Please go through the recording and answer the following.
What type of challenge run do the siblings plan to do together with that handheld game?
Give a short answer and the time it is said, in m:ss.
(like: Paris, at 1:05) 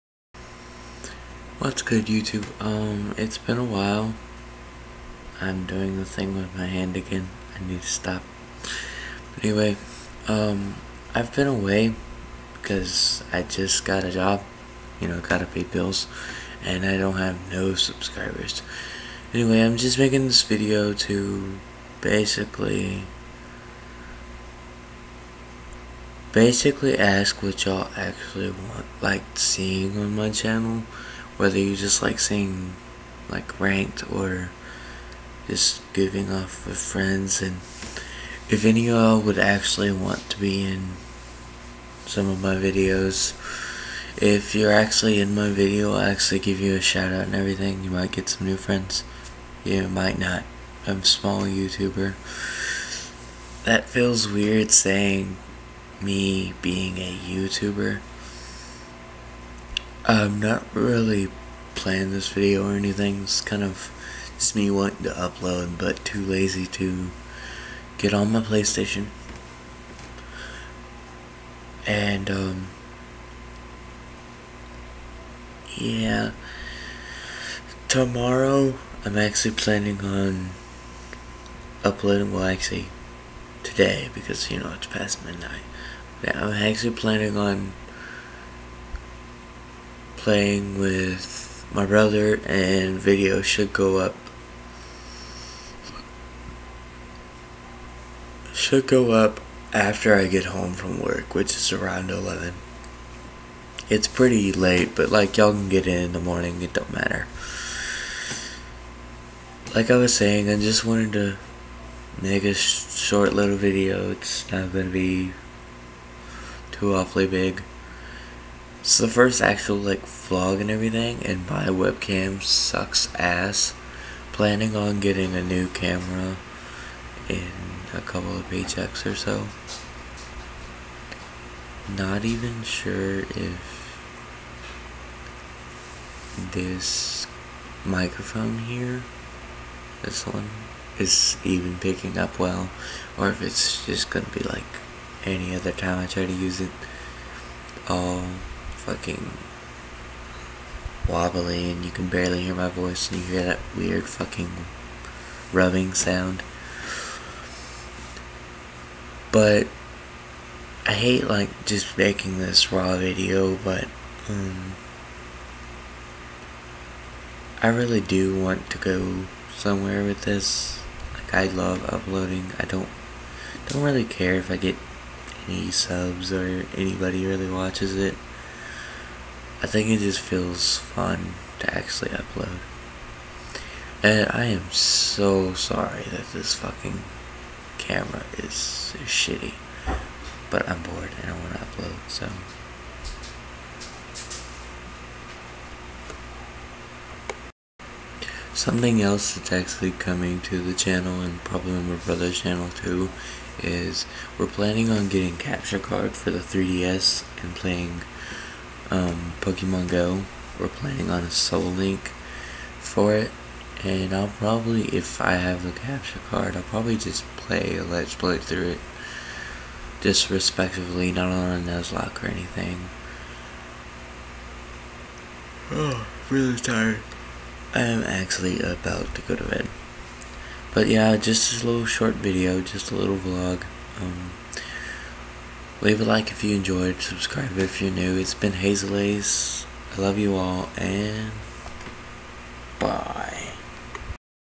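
Soul Link, at 3:31.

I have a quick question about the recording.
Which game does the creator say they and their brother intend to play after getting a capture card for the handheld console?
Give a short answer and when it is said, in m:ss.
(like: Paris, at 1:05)
Pokemon Go, at 3:29.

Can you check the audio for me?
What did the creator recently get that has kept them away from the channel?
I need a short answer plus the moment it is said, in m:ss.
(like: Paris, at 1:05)
A job, at 0:14.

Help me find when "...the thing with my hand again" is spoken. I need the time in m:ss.
0:05.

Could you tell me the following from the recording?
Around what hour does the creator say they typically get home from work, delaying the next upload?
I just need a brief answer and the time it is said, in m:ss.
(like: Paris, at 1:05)
11, at 1:42.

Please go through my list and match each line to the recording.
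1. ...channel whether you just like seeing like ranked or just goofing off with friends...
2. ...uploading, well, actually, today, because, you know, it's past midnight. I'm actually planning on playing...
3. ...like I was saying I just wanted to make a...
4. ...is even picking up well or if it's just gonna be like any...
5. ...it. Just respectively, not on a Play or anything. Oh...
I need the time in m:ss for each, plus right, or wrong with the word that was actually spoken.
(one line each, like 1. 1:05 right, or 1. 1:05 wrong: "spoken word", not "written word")
1. 0:30 right
2. 1:21 right
3. 1:49 right
4. 2:20 right
5. 3:38 wrong: "Nuzlocke", not "Play".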